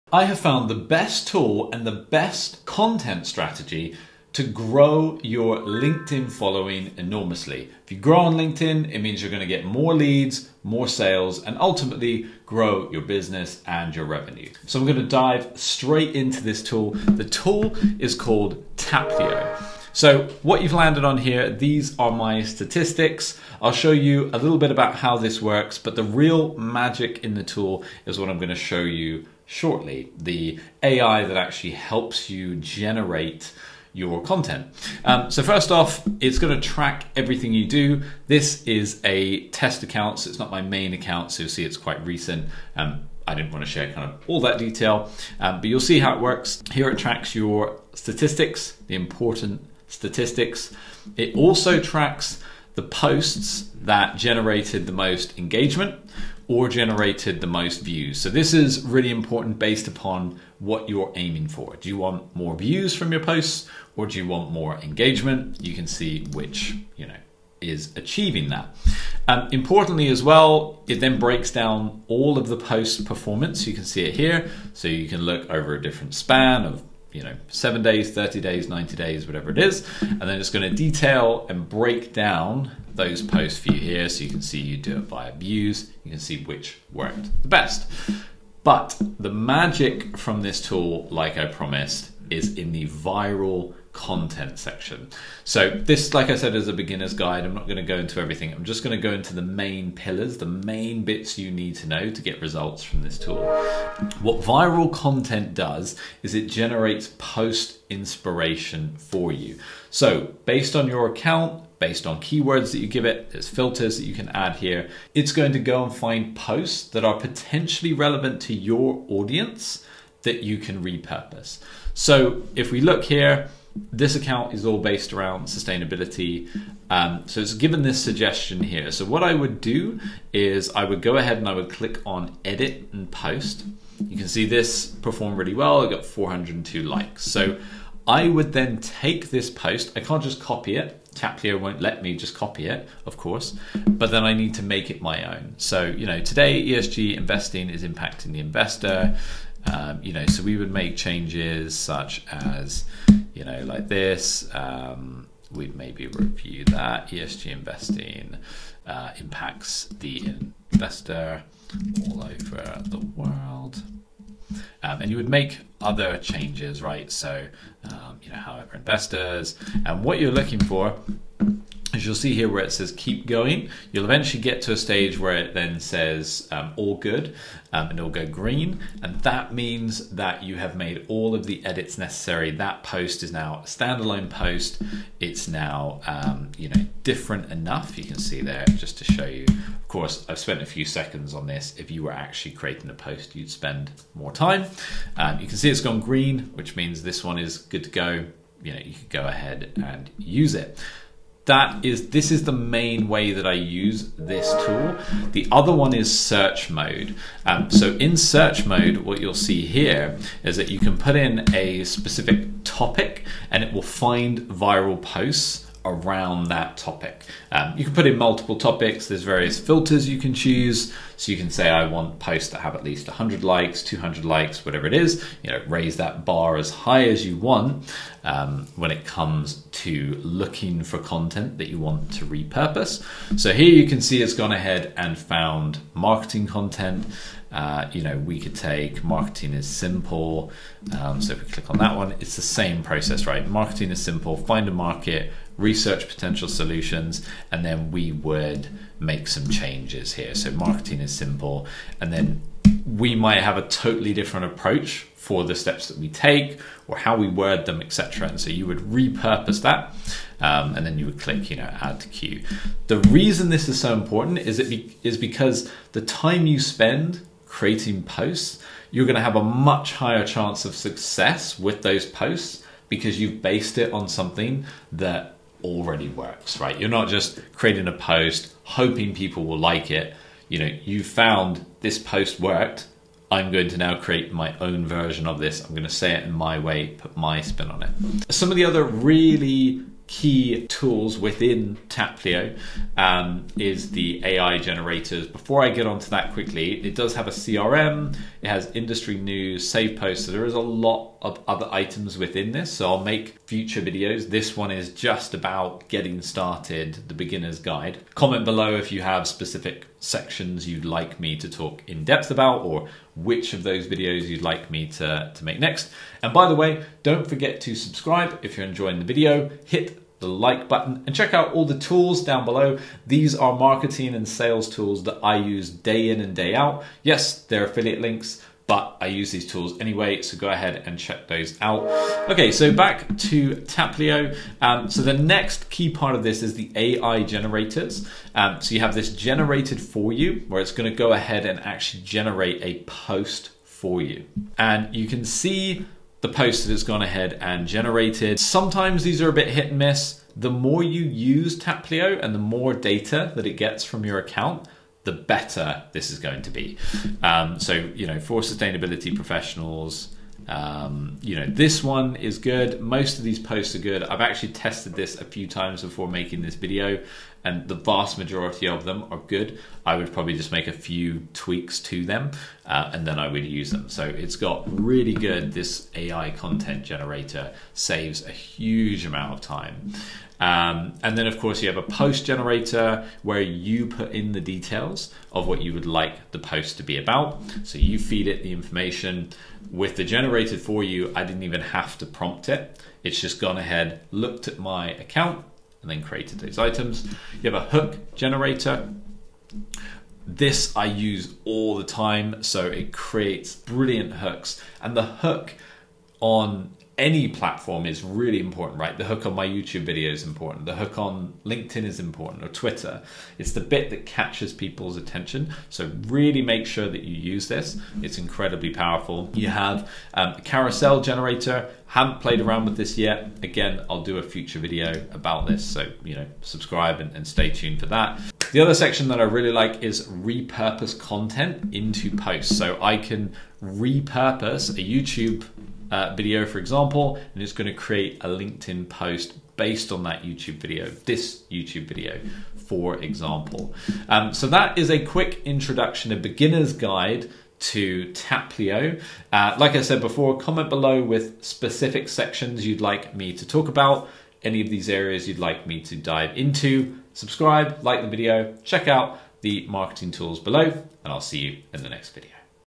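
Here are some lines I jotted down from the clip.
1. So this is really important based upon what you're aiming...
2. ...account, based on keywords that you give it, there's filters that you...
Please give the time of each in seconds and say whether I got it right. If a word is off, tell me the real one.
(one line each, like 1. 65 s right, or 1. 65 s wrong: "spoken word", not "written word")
1. 58 s right
2. 111 s right.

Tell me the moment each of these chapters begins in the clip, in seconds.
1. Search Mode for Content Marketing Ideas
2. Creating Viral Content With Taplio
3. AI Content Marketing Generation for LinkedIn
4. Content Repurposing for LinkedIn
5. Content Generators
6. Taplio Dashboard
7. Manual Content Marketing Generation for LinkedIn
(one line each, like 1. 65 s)
1. 200 s
2. 90 s
3. 333 s
4. 430 s
5. 398 s
6. 28 s
7. 382 s.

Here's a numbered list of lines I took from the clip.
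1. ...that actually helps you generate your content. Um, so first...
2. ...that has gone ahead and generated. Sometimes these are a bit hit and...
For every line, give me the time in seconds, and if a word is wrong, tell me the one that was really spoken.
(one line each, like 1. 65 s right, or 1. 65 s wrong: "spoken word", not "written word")
1. 31 s right
2. 346 s right.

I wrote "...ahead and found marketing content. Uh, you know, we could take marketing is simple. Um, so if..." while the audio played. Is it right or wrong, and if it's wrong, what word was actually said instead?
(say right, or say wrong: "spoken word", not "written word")
right.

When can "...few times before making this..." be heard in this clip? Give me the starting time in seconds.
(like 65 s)
365 s.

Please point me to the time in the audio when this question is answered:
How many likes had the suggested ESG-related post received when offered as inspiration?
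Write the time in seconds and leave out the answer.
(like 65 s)
135 s.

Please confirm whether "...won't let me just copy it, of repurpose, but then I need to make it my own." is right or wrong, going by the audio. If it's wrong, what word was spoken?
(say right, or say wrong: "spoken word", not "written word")
wrong: "course", not "repurpose".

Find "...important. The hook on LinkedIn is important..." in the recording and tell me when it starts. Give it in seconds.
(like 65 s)
410 s.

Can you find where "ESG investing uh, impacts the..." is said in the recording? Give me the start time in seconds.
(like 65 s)
157 s.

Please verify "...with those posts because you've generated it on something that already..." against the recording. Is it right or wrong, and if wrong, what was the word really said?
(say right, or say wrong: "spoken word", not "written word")
wrong: "based", not "generated".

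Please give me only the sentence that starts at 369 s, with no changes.
I would probably just make a few tweaks to them uh, and then I would use them.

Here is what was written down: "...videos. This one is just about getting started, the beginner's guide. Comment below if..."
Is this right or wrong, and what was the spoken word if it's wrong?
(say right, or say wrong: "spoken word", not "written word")
right.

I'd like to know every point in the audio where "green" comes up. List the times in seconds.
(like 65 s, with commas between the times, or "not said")
178 s, 195 s.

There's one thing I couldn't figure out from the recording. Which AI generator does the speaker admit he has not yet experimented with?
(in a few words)
Carousel generator.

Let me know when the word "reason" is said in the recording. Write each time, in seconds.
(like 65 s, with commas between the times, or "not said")
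262 s.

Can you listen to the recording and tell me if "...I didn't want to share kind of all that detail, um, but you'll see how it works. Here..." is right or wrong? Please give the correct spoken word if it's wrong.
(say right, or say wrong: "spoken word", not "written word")
right.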